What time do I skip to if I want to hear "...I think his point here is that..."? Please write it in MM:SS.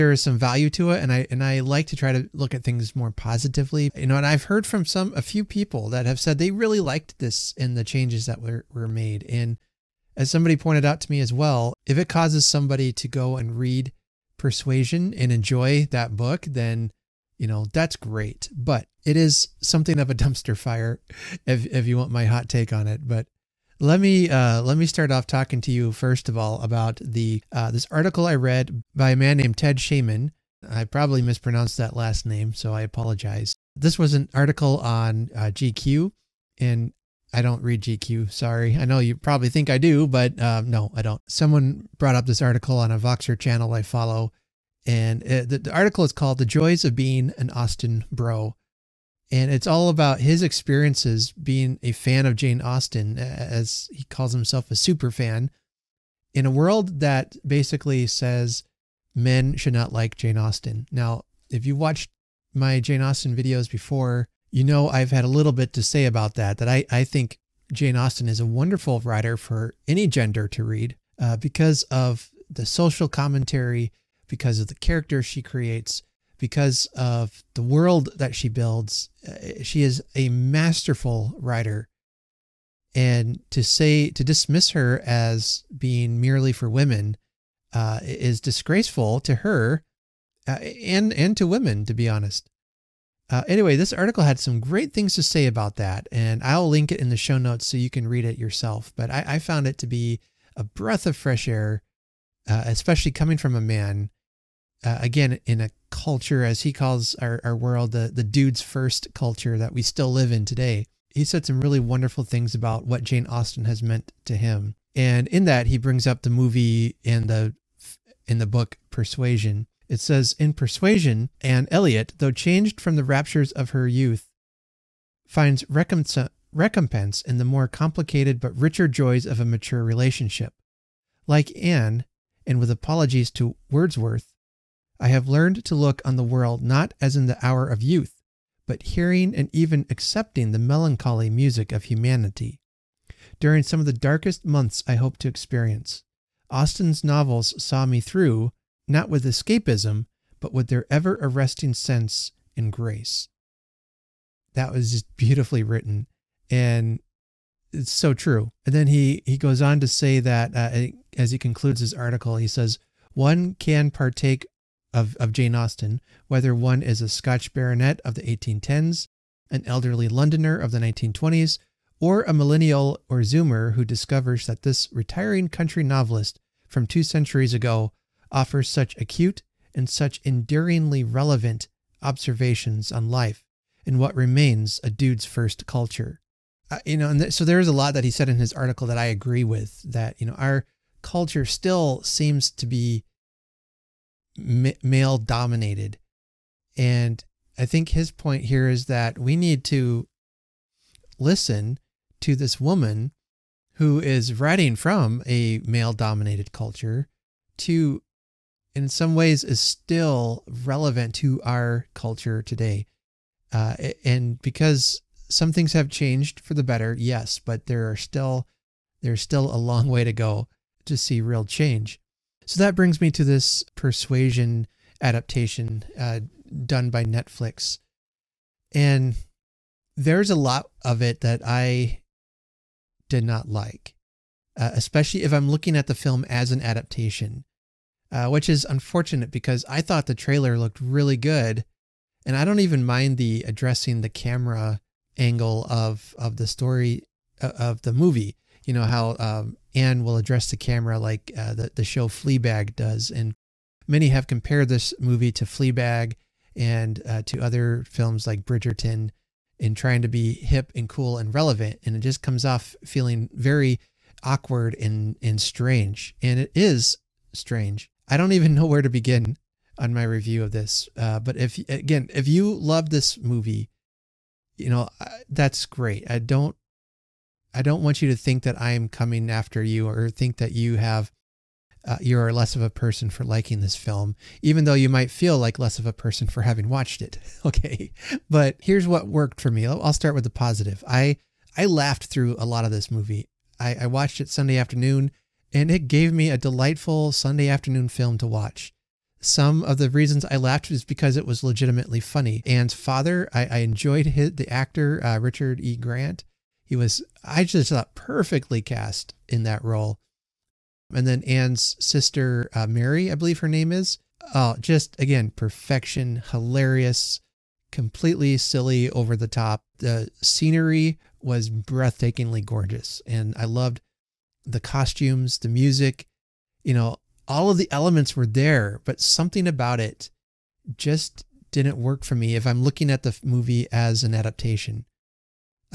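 03:17.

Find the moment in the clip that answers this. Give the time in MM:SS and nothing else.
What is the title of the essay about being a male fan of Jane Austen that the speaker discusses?
00:46.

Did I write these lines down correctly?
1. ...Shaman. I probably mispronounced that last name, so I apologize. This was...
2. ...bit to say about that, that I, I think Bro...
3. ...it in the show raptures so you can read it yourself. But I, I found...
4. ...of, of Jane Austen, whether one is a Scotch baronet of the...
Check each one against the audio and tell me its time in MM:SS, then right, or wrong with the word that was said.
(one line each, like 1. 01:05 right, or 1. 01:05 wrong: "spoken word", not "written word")
1. 00:29 right
2. 01:05 wrong: "Jane", not "Bro"
3. 01:36 wrong: "notes", not "raptures"
4. 02:44 right.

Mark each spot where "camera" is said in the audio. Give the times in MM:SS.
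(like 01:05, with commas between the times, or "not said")
04:04, 04:10.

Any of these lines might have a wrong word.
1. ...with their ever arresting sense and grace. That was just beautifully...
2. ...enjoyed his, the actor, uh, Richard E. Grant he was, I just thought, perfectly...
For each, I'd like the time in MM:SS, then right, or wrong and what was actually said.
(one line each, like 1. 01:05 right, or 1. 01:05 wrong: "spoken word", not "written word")
1. 02:30 right
2. 05:03 right.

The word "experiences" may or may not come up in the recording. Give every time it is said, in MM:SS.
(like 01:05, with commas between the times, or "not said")
00:50, 02:25.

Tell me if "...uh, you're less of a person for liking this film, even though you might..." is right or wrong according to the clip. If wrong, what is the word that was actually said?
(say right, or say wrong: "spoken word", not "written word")
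right.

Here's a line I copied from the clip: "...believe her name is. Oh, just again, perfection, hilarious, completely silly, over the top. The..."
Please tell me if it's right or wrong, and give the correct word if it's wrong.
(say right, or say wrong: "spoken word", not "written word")
right.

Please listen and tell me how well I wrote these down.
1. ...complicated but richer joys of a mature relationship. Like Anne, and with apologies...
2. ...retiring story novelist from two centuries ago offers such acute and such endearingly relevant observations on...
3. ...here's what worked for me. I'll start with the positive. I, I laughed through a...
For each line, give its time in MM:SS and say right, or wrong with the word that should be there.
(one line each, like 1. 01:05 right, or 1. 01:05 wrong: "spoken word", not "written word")
1. 02:07 right
2. 02:54 wrong: "country", not "story"
3. 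04:48 right.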